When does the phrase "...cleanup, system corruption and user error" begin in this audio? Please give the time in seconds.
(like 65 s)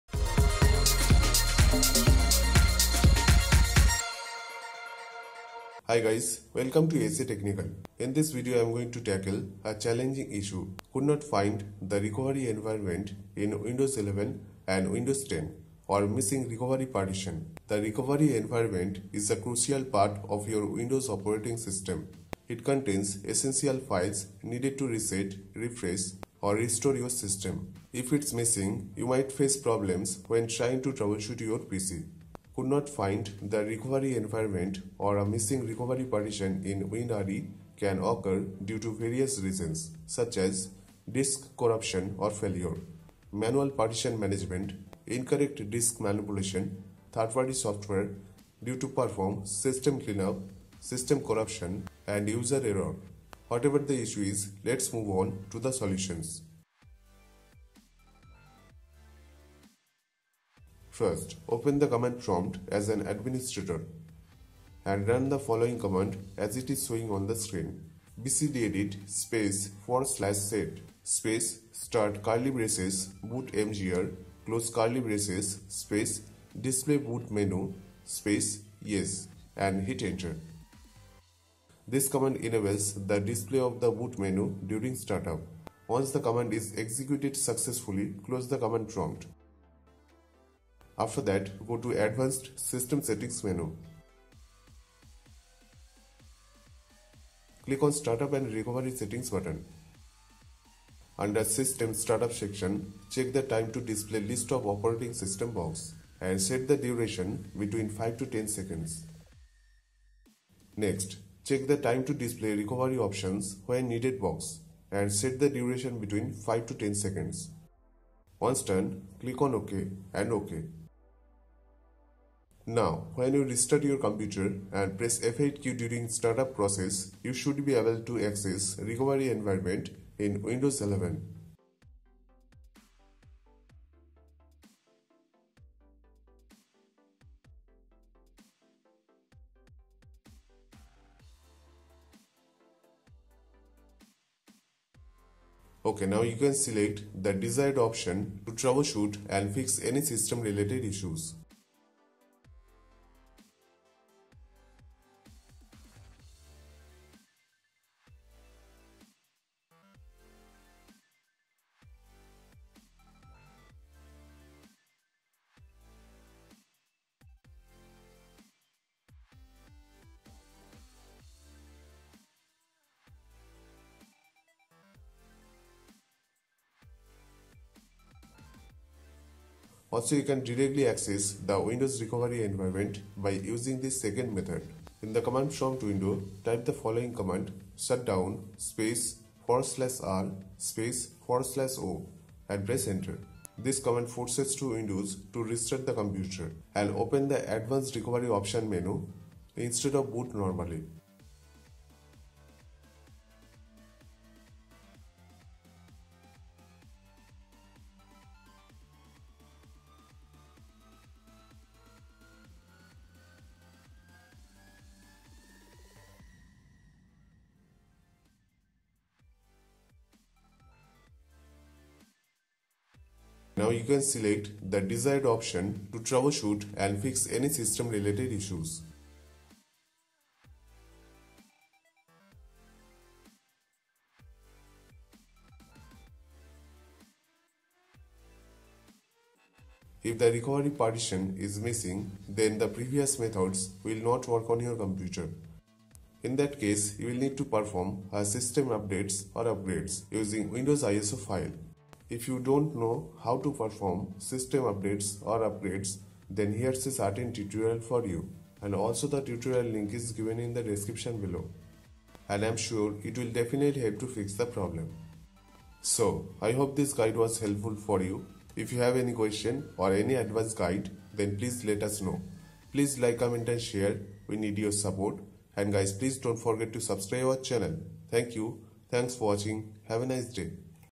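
49 s.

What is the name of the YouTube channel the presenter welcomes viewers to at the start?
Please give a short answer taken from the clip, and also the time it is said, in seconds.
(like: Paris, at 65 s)
ASA Technical, at 7 s.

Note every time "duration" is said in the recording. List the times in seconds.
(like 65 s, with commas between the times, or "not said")
106 s, 115 s.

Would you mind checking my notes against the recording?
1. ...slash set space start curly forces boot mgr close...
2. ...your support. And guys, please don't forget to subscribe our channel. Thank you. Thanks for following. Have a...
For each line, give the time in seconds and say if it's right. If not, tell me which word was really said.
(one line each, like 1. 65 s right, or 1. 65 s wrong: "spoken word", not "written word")
1. 70 s wrong: "braces", not "forces"
2. 274 s wrong: "watching", not "following".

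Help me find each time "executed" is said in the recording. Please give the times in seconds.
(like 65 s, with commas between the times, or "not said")
86 s.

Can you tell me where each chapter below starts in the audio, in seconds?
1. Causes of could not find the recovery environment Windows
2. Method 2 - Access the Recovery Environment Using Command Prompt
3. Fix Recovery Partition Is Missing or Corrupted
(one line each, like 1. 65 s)
1. 38 s
2. 175 s
3. 235 s.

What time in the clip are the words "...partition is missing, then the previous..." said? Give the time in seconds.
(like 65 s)
240 s.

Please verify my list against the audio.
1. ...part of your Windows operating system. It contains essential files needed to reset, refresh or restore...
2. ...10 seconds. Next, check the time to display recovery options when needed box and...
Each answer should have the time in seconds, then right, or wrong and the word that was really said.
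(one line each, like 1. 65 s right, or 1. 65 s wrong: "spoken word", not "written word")
1. 19 s right
2. 108 s right.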